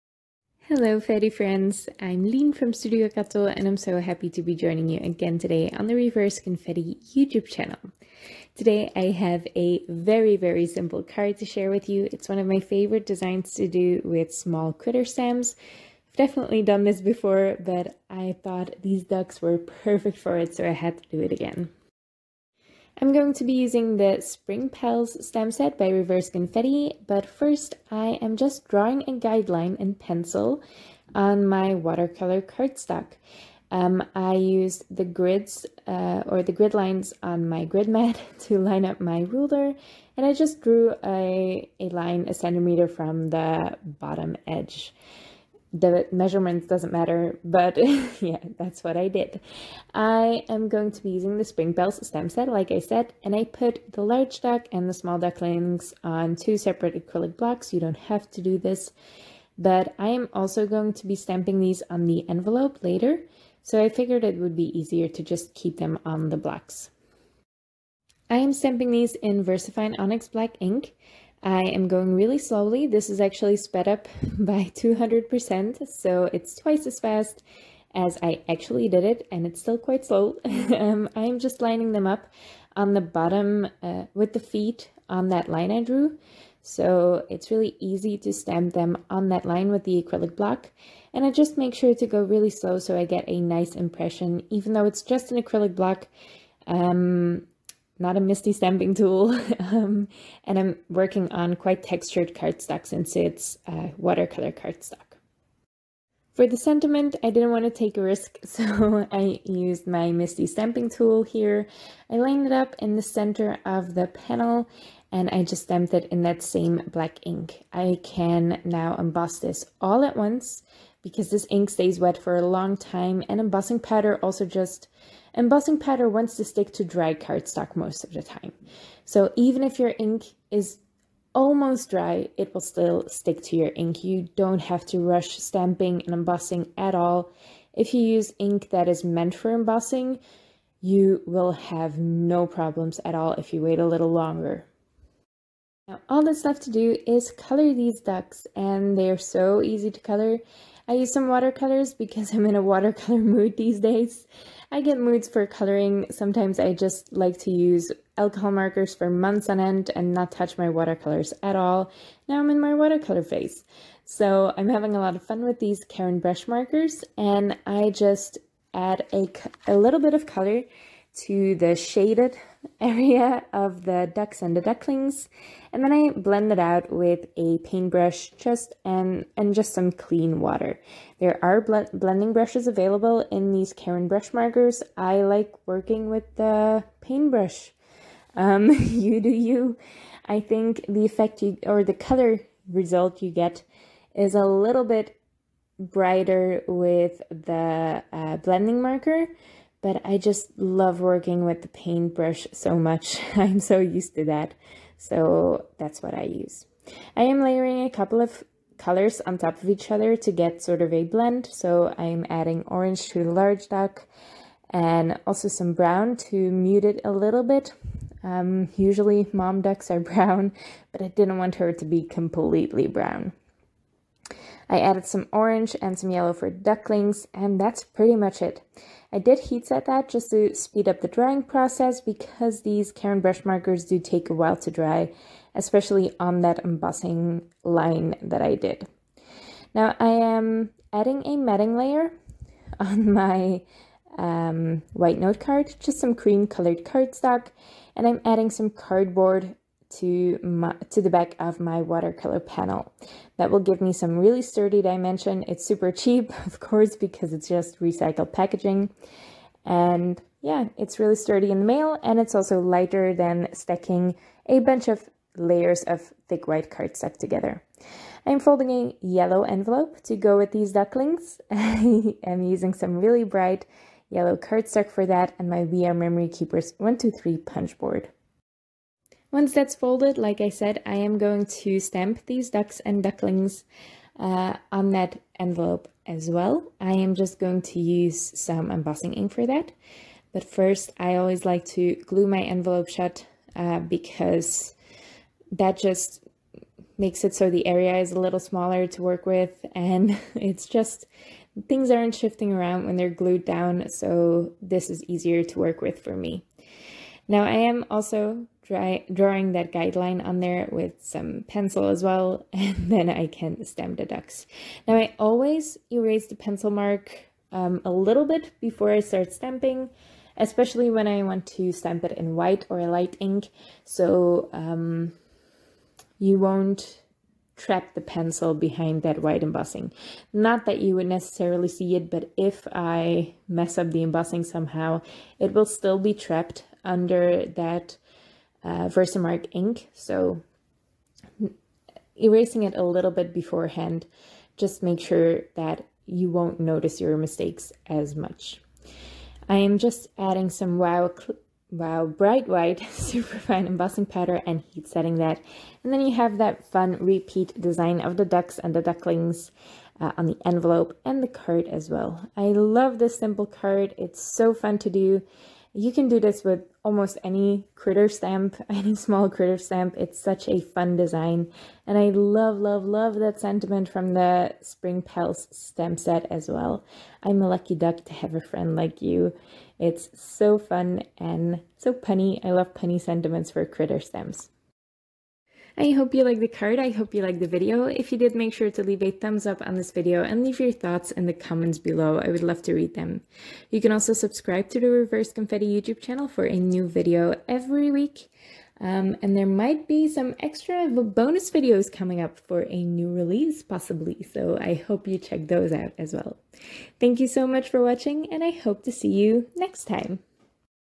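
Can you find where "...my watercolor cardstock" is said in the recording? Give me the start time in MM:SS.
00:31.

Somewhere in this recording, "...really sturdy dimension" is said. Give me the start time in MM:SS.
04:14.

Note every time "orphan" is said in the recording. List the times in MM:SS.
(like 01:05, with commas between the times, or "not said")
not said.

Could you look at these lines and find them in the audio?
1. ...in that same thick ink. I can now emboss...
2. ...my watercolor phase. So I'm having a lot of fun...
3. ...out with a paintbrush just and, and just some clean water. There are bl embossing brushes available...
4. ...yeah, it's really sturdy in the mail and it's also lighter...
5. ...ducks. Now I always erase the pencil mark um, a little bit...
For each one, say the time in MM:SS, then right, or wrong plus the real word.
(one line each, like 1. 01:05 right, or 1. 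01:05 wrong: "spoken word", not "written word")
1. 01:56 wrong: "black", not "thick"
2. 02:42 right
3. 02:56 wrong: "blending", not "embossing"
4. 04:20 right
5. 05:14 right.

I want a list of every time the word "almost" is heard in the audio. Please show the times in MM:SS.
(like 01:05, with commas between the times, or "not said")
02:11, 06:06.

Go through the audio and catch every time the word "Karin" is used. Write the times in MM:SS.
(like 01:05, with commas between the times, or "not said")
02:45, 03:03, 03:52.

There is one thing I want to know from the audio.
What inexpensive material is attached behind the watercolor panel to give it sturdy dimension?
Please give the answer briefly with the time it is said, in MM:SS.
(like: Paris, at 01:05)
Cardboard, at 04:08.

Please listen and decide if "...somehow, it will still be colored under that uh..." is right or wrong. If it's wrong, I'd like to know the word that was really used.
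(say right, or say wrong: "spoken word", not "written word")
wrong: "trapped", not "colored".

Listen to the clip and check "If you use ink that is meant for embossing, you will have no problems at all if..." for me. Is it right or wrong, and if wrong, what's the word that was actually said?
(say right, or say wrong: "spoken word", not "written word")
right.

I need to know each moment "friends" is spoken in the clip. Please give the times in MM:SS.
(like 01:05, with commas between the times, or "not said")
00:01, 06:18.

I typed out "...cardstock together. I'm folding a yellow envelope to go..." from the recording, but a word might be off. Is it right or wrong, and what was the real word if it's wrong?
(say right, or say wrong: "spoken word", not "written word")
right.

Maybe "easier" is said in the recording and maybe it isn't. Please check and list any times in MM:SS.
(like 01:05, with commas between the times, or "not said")
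01:04, 05:05.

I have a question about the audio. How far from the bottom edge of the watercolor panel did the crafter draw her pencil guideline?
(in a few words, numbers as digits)
1 centimeter.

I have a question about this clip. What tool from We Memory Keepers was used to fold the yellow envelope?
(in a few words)
123 punch board.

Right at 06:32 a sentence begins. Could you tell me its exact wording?
I would love to read them.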